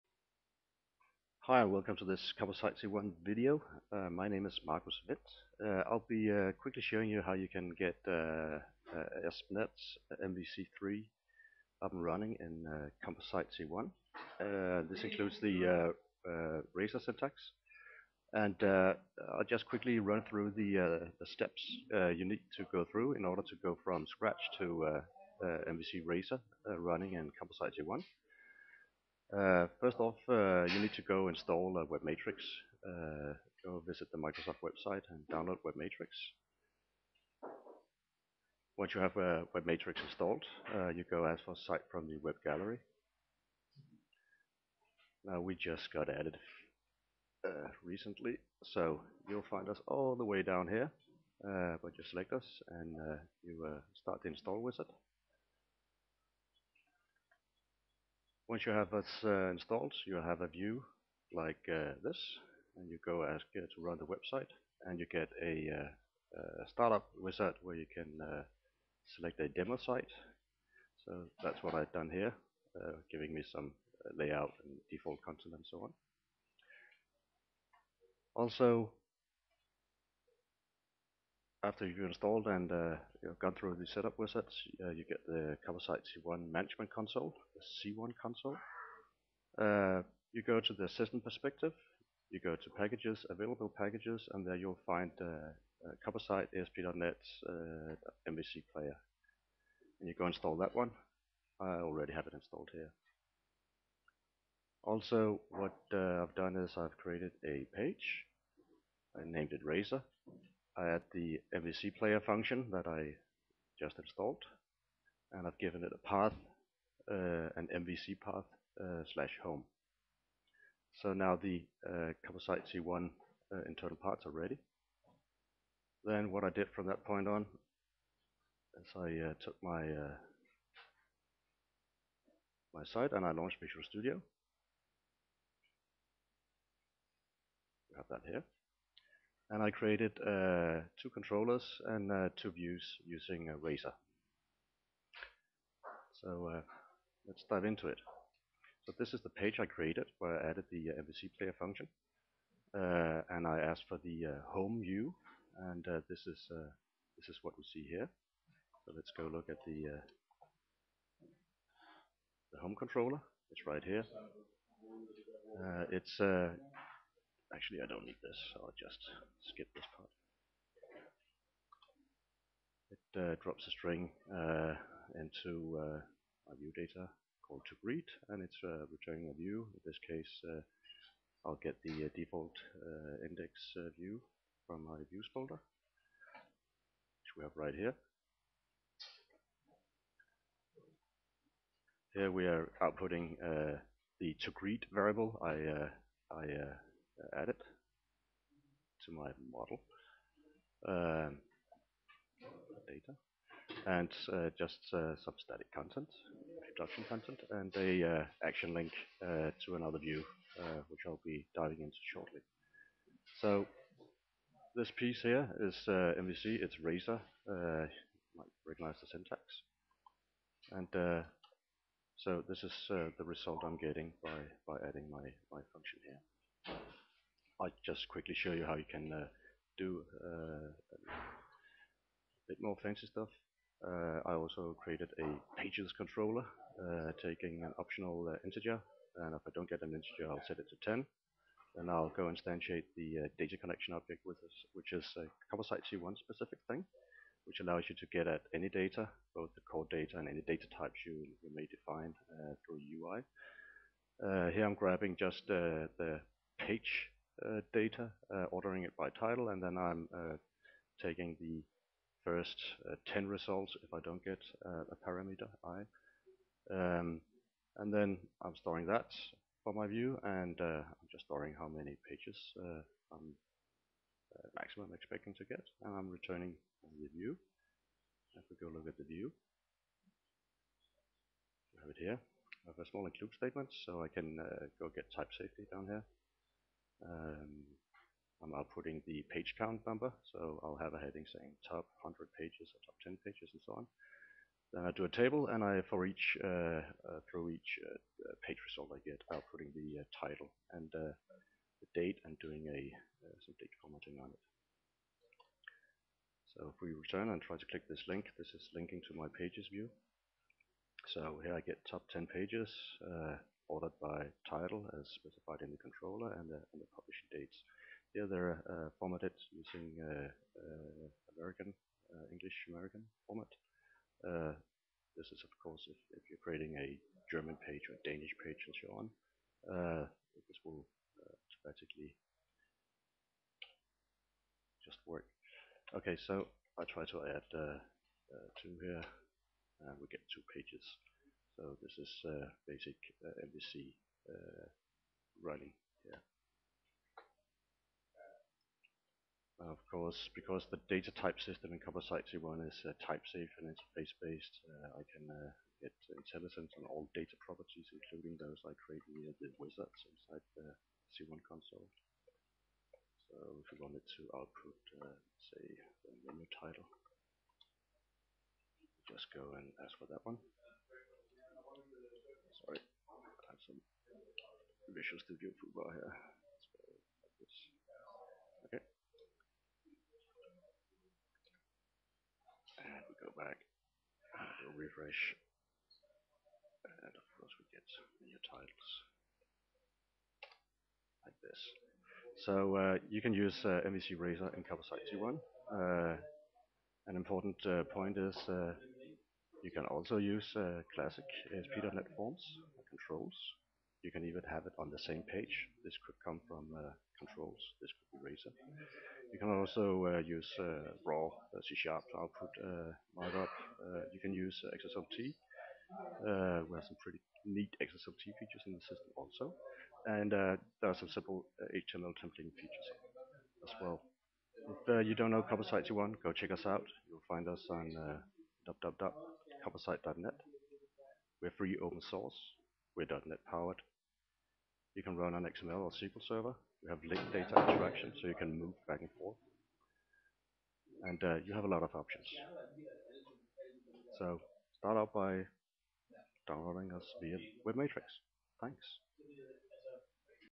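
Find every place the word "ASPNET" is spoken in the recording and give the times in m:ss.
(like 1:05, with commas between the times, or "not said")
0:09, 1:36, 6:41.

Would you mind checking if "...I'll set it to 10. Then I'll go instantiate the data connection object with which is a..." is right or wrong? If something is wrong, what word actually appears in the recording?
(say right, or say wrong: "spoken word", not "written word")
right.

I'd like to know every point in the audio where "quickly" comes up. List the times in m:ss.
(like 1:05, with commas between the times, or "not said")
0:06, 0:19, 3:48.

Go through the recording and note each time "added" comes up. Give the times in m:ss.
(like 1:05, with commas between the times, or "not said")
0:46, 2:30.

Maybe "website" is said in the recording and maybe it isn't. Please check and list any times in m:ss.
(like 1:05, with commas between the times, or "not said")
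0:34, 1:04.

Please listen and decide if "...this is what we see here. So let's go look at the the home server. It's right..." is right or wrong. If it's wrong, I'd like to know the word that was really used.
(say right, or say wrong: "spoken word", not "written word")
wrong: "controller", not "server".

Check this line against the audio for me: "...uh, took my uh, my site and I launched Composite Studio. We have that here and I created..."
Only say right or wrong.
wrong.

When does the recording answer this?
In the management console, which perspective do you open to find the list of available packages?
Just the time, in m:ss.
1:30.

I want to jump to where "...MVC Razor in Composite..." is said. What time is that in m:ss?
6:33.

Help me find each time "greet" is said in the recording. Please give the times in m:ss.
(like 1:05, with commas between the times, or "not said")
2:57, 3:14.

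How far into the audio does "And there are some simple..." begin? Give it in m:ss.
7:00.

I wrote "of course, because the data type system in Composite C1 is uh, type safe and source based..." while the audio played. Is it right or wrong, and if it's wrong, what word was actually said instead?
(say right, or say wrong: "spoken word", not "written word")
wrong: "interface", not "source".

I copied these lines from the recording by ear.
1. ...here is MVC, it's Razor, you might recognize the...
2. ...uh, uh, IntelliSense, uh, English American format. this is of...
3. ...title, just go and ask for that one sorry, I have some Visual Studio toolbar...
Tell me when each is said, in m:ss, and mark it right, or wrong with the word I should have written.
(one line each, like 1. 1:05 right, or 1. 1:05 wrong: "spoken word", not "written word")
1. 3:35 right
2. 5:20 wrong: "American", not "IntelliSense"
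3. 6:06 right.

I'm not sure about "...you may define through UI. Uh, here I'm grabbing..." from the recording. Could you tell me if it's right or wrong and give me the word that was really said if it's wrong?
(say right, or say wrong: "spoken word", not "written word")
right.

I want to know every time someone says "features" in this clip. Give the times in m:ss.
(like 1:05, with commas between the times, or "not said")
6:58, 7:02.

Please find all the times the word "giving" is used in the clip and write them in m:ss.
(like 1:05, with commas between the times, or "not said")
1:13.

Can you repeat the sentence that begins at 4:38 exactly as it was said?
If we go look at the view, I have it here.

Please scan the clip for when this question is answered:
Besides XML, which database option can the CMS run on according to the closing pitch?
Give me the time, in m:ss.
7:15.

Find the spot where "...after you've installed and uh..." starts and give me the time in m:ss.
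1:21.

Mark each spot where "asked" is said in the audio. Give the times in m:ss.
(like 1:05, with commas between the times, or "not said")
2:33.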